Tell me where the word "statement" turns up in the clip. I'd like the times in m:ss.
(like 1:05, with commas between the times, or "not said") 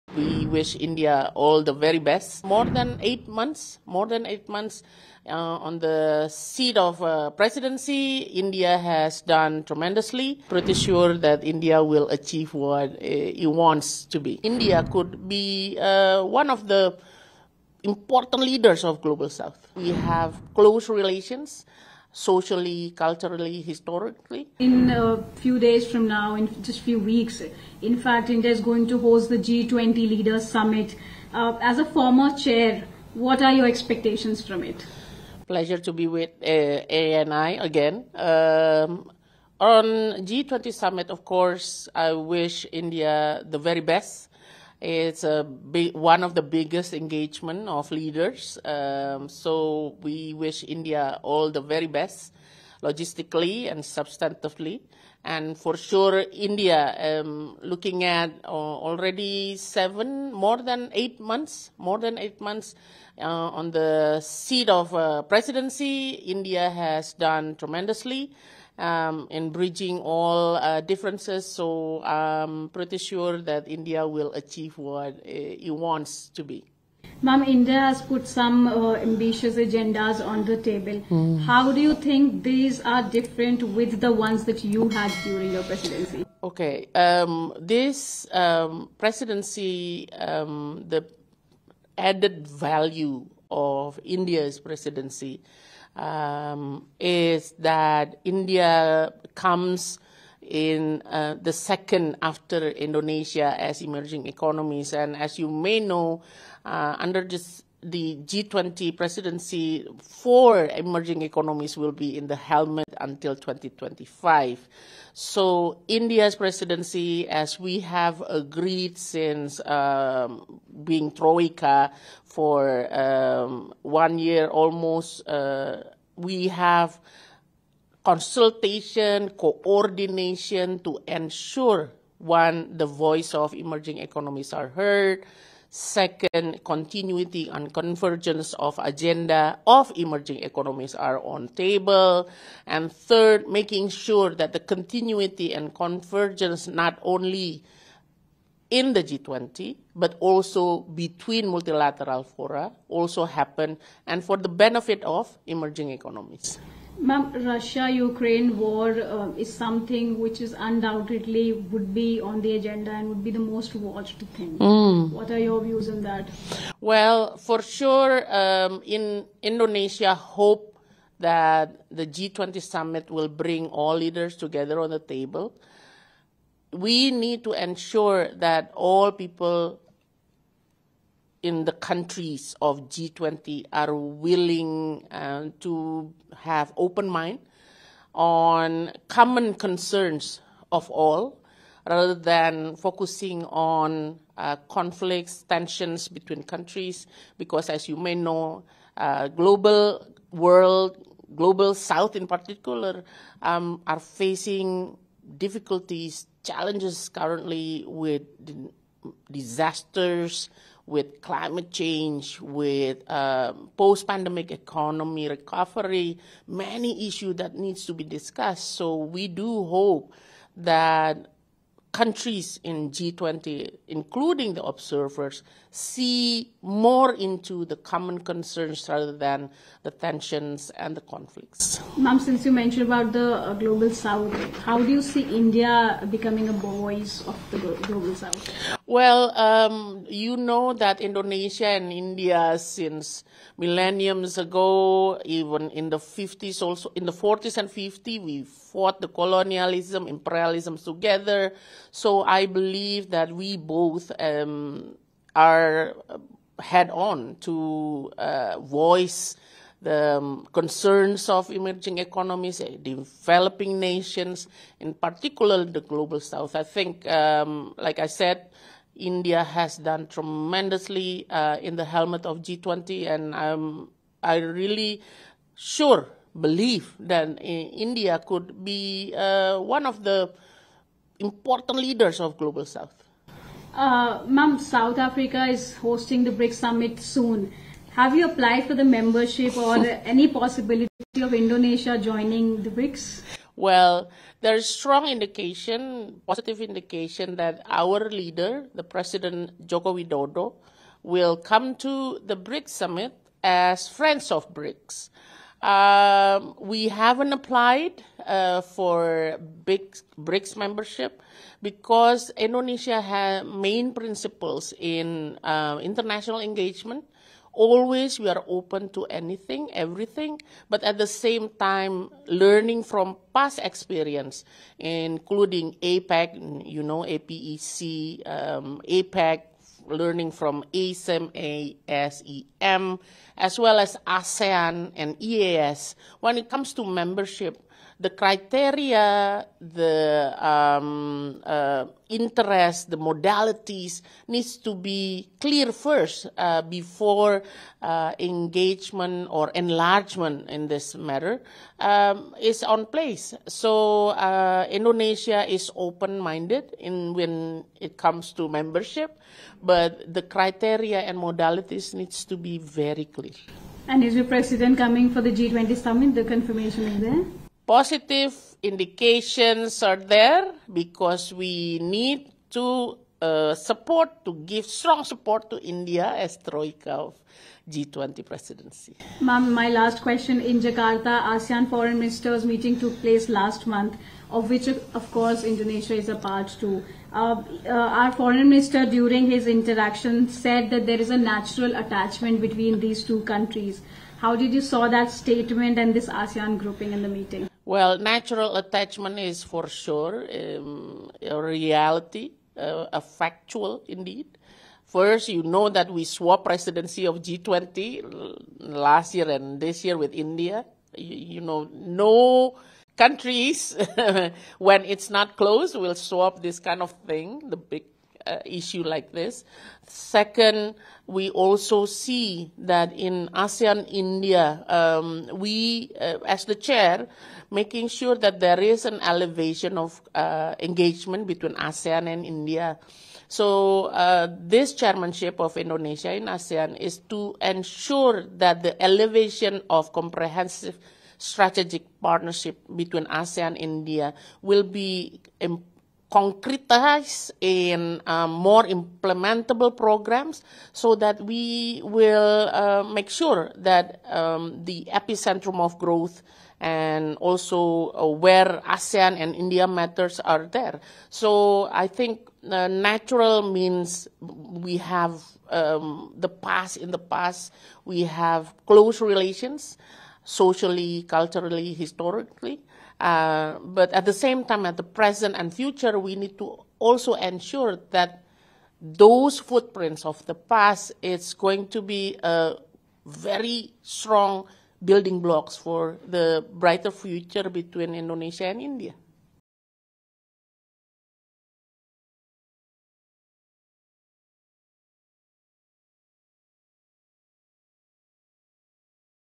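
6:35.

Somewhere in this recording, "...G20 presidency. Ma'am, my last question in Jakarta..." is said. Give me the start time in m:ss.
6:17.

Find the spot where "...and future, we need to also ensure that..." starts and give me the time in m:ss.
7:55.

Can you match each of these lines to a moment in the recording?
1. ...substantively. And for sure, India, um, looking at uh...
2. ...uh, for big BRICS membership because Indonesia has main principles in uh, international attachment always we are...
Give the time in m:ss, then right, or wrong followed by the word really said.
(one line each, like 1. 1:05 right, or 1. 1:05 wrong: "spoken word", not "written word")
1. 0:53 right
2. 5:08 wrong: "engagement", not "attachment".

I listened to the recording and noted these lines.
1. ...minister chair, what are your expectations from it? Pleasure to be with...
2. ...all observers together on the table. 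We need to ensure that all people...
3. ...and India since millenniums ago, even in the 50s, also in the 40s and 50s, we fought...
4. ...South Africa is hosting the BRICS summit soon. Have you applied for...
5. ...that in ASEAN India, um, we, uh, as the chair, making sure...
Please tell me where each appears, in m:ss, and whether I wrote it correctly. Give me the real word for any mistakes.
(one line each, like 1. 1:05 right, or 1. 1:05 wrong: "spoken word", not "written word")
1. 0:31 wrong: "former", not "minister"
2. 2:53 wrong: "leaders", not "observers"
3. 4:01 right
4. 4:44 right
5. 7:02 right.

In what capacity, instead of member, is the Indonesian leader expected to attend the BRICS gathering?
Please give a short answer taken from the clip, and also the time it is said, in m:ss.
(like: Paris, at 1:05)
friends of BRICS, at 5:03.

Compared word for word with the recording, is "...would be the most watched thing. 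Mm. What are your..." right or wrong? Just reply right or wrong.
right.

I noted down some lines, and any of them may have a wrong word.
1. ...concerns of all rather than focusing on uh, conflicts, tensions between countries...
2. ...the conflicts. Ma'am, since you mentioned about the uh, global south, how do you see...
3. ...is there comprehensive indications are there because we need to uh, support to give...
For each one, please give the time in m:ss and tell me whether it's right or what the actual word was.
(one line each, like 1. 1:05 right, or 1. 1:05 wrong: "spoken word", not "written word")
1. 3:09 right
2. 3:50 right
3. 6:06 wrong: "positive", not "comprehensive".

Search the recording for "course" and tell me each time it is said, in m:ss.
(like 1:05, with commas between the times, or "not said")
0:41, 6:25.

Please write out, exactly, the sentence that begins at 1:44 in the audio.
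And as you may know, uh, under this the G20 presidency for emerging economies will be in the helmet until 2025.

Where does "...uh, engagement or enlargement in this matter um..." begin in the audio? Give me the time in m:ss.
5:47.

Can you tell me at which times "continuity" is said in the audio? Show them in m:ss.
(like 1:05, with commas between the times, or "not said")
2:16, 2:24.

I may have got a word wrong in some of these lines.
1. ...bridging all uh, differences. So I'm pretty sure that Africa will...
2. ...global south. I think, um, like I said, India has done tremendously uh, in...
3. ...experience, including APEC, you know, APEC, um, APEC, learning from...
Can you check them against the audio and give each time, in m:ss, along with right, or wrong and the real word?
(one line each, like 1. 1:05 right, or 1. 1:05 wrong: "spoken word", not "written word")
1. 1:09 wrong: "India", not "Africa"
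2. 4:25 right
3. 5:23 right.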